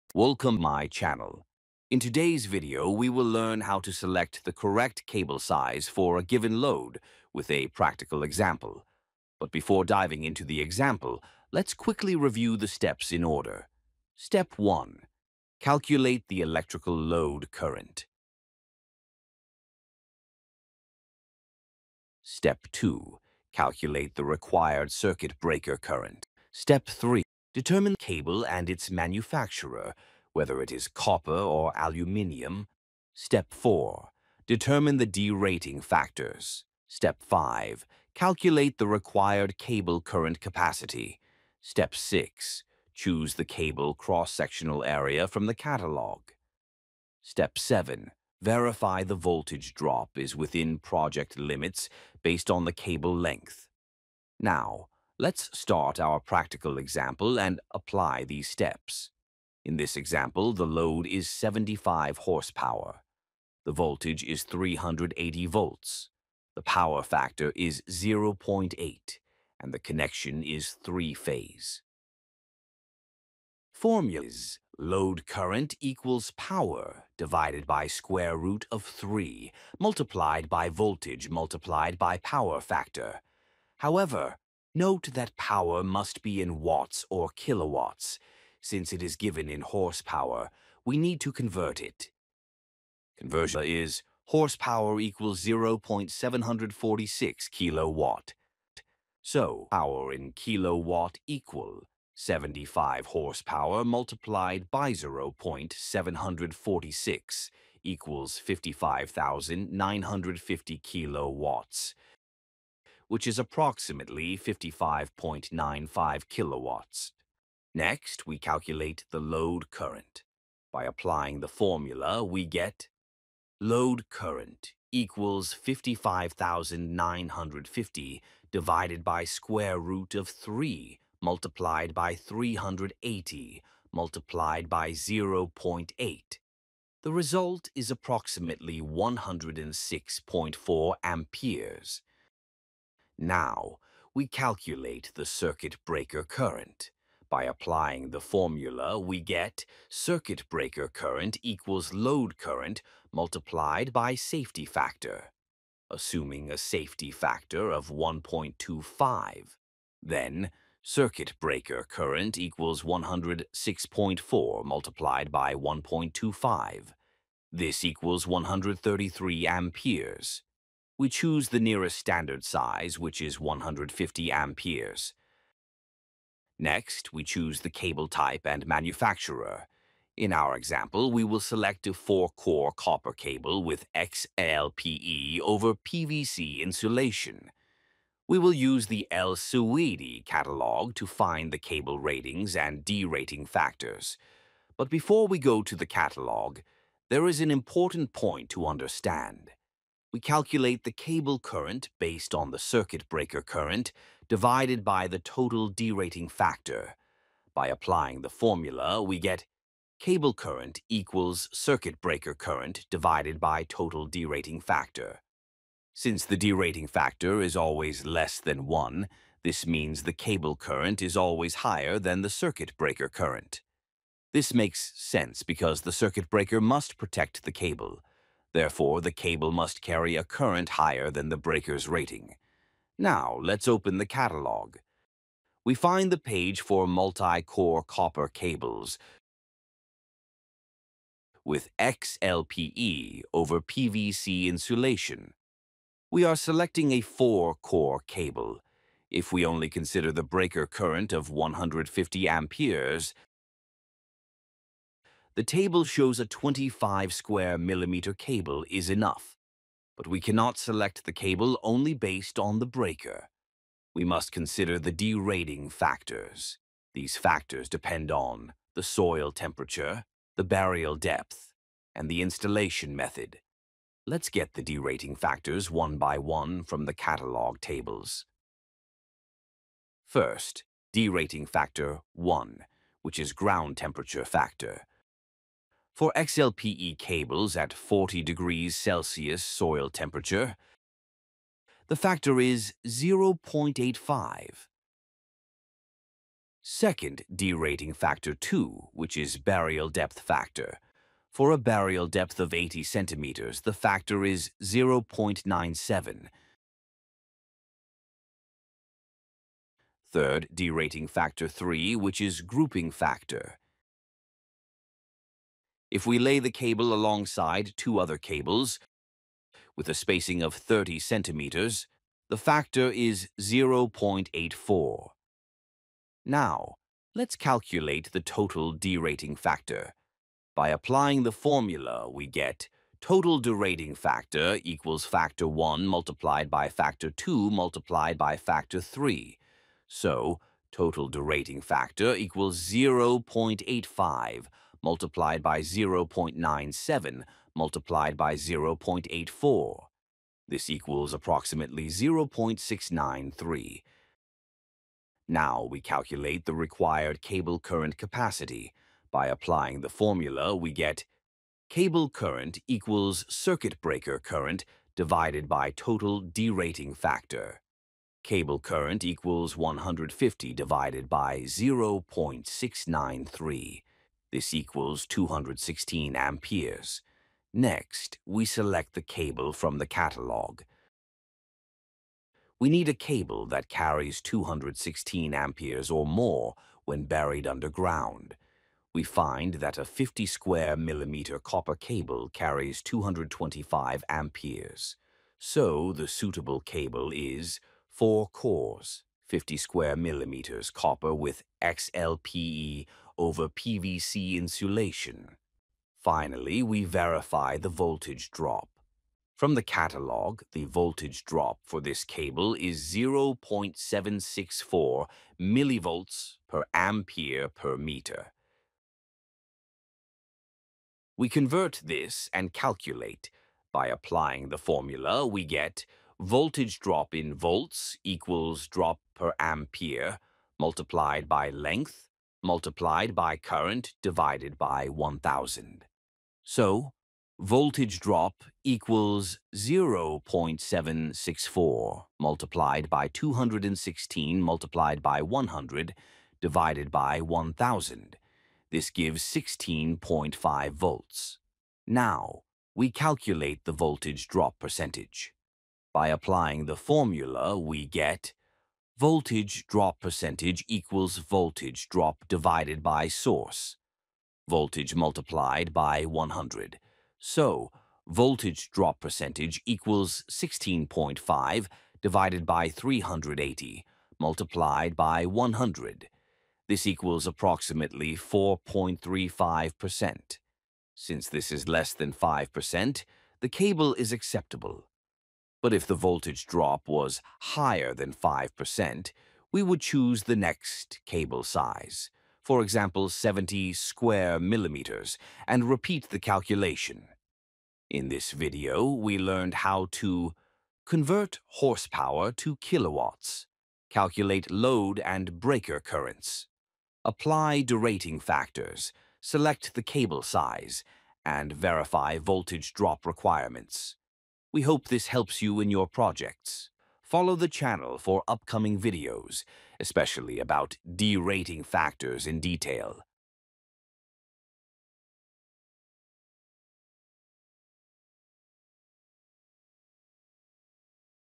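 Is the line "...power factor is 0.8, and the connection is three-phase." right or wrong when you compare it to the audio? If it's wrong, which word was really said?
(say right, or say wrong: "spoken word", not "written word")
right.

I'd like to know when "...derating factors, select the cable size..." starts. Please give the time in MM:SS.
08:27.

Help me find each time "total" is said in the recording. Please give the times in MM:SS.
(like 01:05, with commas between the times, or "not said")
03:25, 03:33, 05:28, 05:33, 05:40, 06:05.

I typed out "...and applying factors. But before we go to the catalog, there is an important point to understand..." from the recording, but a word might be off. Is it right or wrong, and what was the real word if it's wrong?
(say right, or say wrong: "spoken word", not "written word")
wrong: "derating", not "applying".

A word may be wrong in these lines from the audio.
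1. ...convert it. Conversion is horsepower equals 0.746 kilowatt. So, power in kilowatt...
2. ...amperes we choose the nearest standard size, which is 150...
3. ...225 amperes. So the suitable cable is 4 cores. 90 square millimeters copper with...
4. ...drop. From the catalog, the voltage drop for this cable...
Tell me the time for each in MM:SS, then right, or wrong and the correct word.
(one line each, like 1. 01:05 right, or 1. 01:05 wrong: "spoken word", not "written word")
1. 01:31 right
2. 02:49 right
3. 06:32 wrong: "50", not "90"
4. 06:48 right.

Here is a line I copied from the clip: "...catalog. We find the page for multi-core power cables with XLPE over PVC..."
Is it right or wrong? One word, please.
wrong.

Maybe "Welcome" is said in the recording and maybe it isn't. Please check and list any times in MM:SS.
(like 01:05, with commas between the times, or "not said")
00:00.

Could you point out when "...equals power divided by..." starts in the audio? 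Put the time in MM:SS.
01:15.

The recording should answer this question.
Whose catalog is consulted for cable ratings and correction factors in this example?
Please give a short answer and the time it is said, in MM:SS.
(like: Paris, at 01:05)
El Sewedy, at 03:09.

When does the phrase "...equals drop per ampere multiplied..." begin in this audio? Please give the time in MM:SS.
07:08.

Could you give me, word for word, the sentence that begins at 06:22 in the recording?
We need a cable that carries 216 amperes or more when buried underground.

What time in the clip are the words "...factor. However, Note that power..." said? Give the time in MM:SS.
01:22.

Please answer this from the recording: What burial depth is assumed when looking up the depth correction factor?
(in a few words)
80 centimeters.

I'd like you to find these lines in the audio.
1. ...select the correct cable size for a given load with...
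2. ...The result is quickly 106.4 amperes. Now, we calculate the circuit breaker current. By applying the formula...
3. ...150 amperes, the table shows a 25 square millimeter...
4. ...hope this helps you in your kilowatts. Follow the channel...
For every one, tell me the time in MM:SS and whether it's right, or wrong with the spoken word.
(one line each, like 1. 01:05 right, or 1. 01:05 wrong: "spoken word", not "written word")
1. 00:03 right
2. 02:17 wrong: "approximately", not "quickly"
3. 04:11 right
4. 08:34 wrong: "projects", not "kilowatts".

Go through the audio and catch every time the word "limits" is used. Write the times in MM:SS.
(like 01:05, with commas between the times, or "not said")
00:51.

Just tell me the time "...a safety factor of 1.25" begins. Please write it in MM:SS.
02:36.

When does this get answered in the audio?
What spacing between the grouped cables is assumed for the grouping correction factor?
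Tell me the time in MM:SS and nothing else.
05:20.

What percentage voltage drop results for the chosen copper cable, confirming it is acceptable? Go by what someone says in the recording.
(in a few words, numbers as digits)
4.35%.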